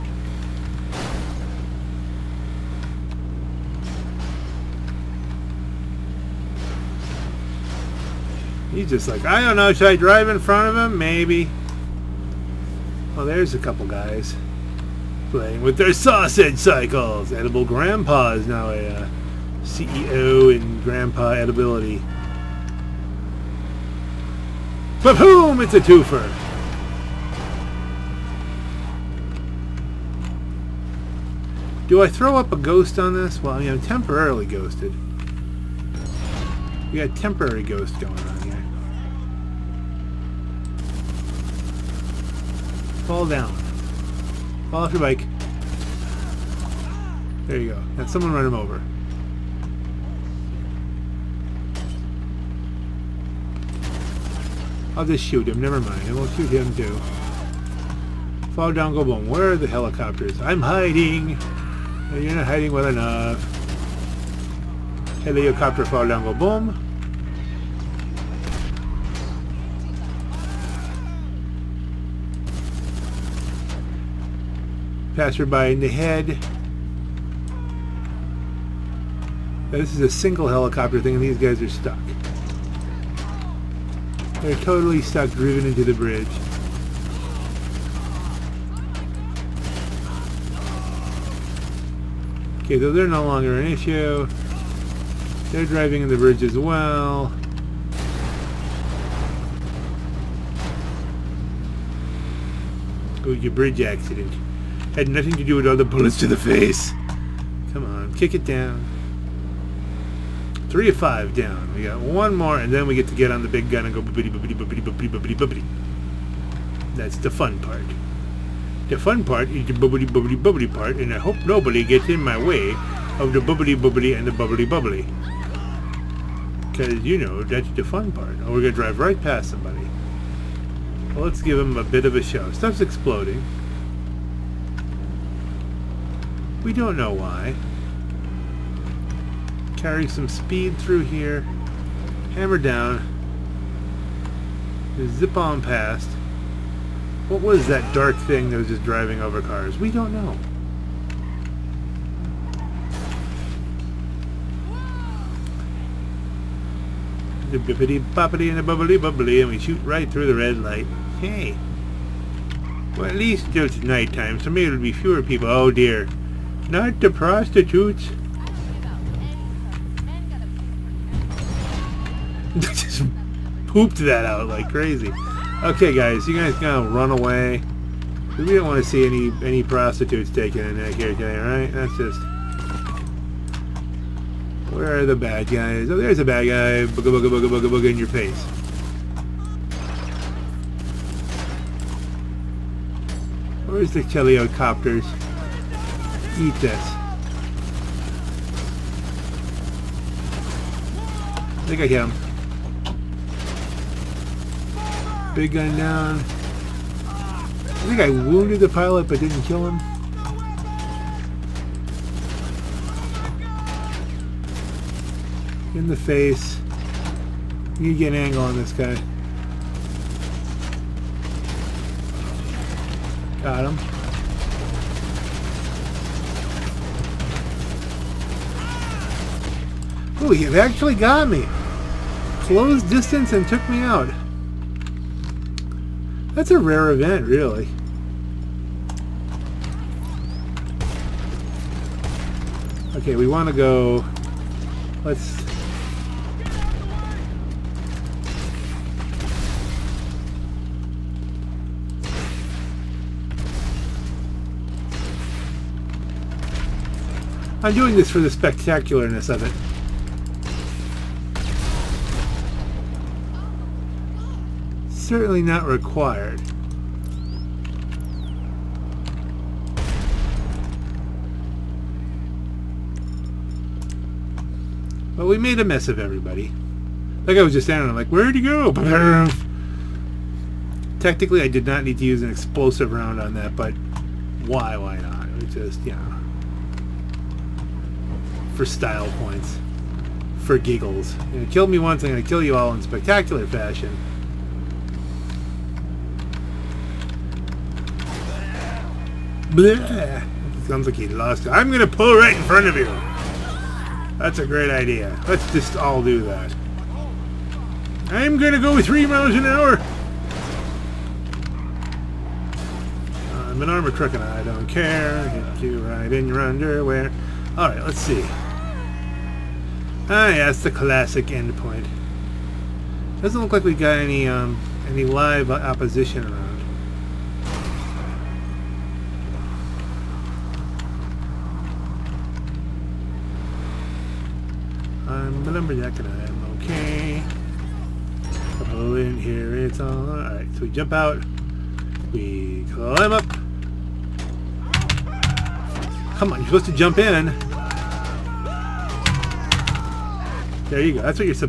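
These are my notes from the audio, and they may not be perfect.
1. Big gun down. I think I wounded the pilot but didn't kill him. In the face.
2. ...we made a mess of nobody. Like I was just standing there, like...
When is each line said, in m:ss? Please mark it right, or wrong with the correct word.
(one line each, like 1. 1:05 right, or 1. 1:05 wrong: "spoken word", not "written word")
1. 3:25 right
2. 4:35 wrong: "everybody", not "nobody".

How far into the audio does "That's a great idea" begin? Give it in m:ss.
5:04.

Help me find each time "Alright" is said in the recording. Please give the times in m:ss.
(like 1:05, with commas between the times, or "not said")
5:17, 5:40.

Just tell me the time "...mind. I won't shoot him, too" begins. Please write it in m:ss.
0:55.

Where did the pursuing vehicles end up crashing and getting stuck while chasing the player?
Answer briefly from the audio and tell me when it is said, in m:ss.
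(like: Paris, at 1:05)
Into the bridge, at 1:25.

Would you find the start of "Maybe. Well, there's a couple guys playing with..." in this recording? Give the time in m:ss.
0:10.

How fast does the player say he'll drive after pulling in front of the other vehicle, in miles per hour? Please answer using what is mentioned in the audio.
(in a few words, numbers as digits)
3.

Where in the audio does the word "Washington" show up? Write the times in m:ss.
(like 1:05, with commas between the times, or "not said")
not said.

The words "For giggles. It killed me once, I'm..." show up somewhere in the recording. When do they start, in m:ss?
4:50.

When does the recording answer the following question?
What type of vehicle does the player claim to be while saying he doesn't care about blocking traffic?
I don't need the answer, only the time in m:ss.
5:13.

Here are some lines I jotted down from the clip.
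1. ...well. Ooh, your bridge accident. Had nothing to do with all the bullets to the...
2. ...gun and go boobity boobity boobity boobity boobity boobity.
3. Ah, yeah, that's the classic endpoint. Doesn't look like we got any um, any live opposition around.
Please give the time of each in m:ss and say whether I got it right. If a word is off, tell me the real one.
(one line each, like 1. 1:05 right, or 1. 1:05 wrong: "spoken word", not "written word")
1. 1:36 right
2. 1:53 right
3. 5:20 right.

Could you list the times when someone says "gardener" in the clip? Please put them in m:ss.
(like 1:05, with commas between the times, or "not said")
not said.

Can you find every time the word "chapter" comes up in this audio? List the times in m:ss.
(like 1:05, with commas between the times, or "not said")
not said.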